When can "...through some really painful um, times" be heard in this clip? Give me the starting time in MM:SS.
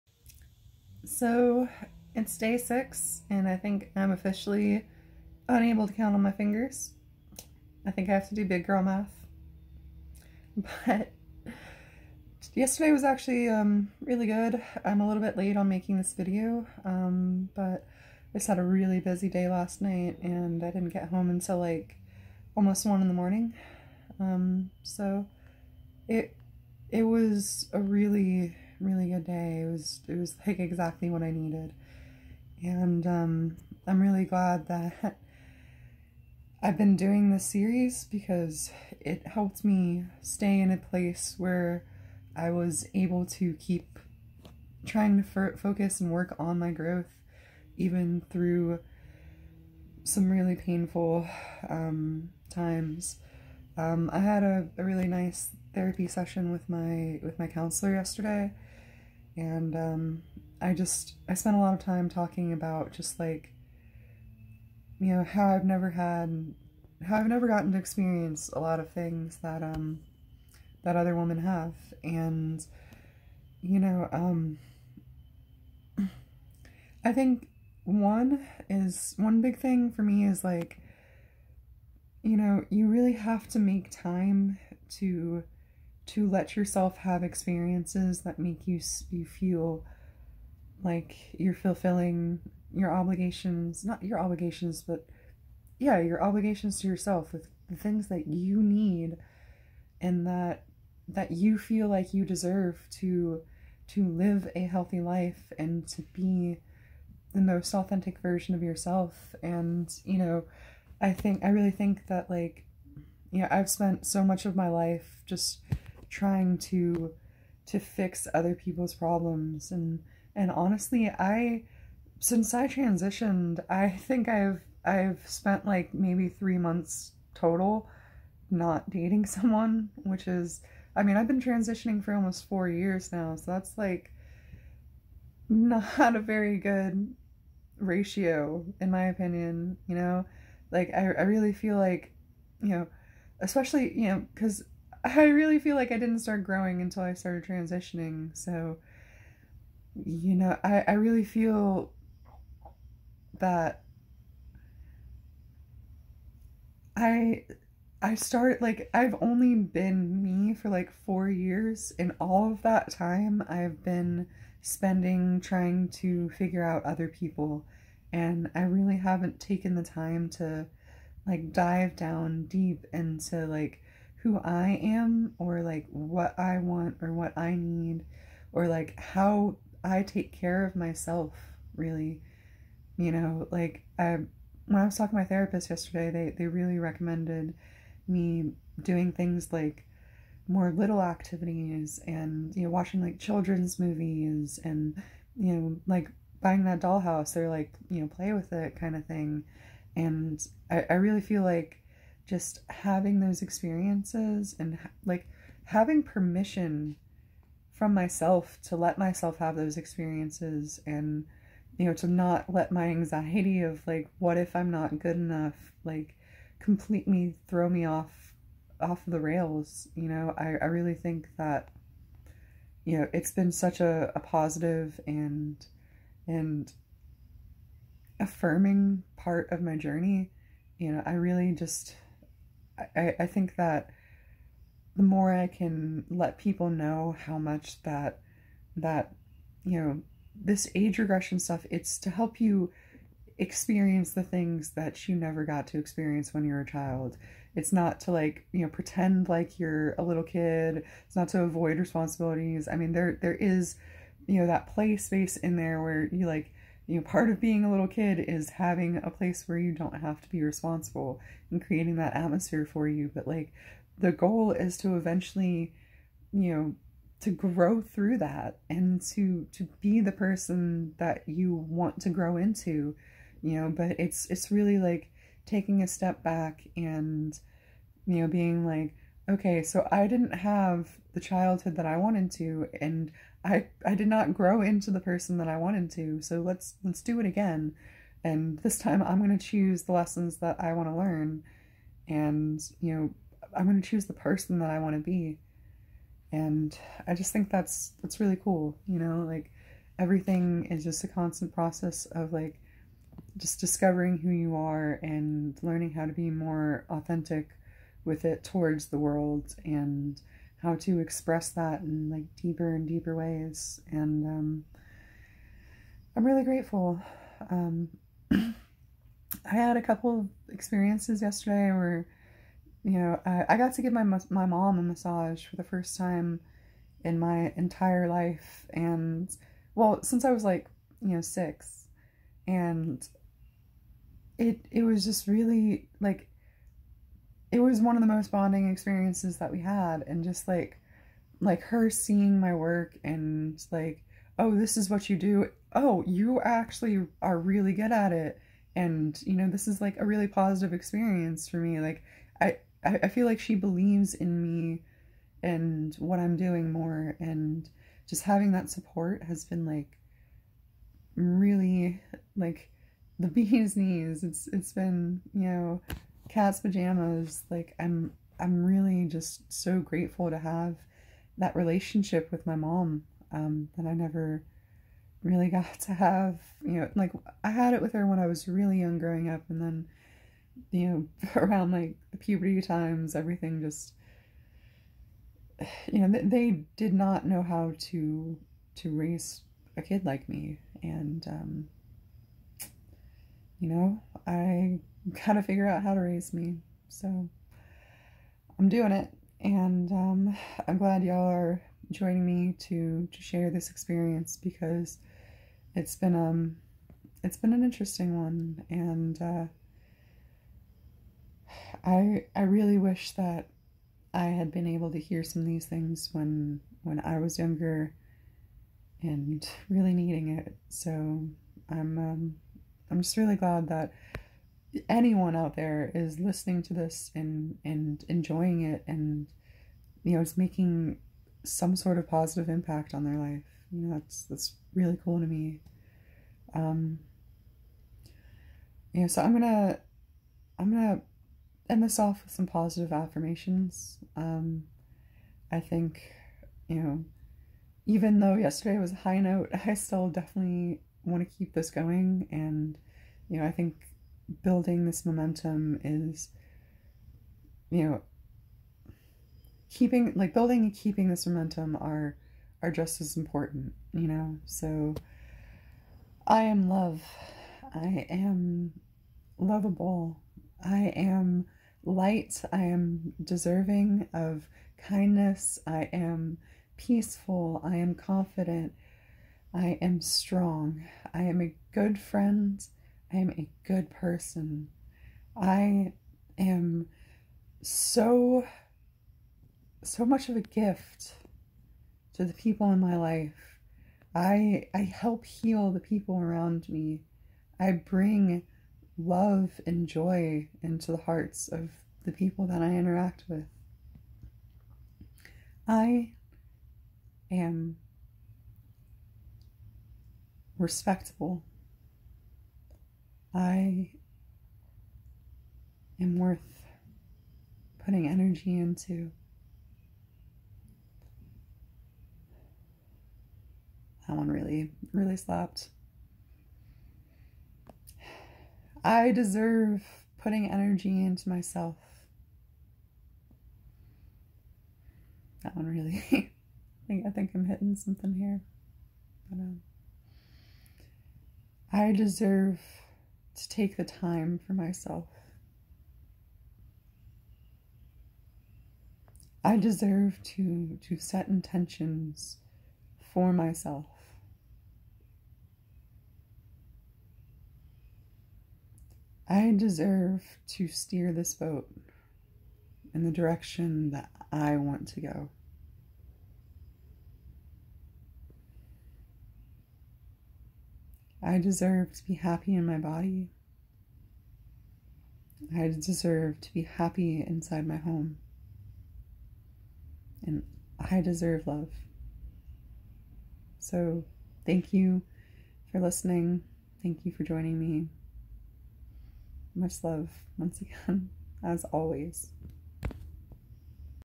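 00:48.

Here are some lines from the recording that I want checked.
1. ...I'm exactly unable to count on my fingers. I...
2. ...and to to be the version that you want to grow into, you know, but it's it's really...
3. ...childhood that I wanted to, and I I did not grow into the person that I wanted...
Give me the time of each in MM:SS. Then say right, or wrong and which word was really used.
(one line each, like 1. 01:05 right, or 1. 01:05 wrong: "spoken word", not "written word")
1. 00:03 wrong: "officially", not "exactly"
2. 04:28 wrong: "person", not "version"
3. 04:41 right.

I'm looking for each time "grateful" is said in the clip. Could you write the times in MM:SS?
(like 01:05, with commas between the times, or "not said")
05:16, 06:09.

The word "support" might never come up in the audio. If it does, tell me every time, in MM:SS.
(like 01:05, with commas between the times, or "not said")
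05:58.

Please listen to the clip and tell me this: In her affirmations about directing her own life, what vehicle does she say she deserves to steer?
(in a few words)
boat.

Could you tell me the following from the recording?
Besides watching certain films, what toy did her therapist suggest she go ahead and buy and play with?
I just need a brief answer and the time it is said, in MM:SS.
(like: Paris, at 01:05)
dollhouse, at 03:16.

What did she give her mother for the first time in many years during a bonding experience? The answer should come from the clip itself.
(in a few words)
a massage.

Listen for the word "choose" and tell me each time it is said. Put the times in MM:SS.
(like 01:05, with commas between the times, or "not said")
04:49, 04:53.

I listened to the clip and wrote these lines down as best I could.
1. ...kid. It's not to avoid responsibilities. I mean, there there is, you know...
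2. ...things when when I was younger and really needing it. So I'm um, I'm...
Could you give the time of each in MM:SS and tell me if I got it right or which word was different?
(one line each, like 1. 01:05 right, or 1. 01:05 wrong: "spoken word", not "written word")
1. 04:10 right
2. 06:55 right.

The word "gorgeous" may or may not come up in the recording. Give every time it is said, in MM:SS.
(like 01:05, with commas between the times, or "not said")
not said.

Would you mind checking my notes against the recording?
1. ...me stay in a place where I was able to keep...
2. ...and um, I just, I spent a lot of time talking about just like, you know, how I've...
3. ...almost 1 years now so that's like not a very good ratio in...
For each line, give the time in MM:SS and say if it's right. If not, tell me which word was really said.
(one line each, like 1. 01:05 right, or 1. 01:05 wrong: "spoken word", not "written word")
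1. 00:39 right
2. 00:59 right
3. 02:12 wrong: "4", not "1".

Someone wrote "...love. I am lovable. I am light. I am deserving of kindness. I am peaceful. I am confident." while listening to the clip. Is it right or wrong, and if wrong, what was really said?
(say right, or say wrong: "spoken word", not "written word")
right.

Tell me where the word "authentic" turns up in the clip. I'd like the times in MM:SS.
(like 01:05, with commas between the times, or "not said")
01:47, 05:06.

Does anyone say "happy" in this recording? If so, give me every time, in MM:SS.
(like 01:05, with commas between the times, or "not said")
09:32, 09:36.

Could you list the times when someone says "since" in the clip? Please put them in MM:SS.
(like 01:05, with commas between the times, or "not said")
02:02, 05:30.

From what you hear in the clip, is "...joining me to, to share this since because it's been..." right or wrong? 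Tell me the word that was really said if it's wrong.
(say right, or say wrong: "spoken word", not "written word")
wrong: "experience", not "since".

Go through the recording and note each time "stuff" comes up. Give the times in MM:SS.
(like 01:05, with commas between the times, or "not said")
04:01.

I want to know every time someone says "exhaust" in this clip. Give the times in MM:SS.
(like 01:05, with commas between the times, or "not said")
not said.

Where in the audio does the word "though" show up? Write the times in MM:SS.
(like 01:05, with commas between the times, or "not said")
07:28.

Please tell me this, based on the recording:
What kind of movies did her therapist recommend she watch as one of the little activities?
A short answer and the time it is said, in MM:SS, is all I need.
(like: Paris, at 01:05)
children's movies, at 03:13.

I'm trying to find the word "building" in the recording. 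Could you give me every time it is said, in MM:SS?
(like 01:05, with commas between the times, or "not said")
07:34, 07:40.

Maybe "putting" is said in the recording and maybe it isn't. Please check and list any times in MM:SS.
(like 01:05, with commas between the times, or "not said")
08:37, 08:50.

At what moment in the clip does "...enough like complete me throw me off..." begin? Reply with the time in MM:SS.
03:35.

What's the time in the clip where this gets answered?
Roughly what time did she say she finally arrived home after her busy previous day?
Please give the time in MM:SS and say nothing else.
00:22.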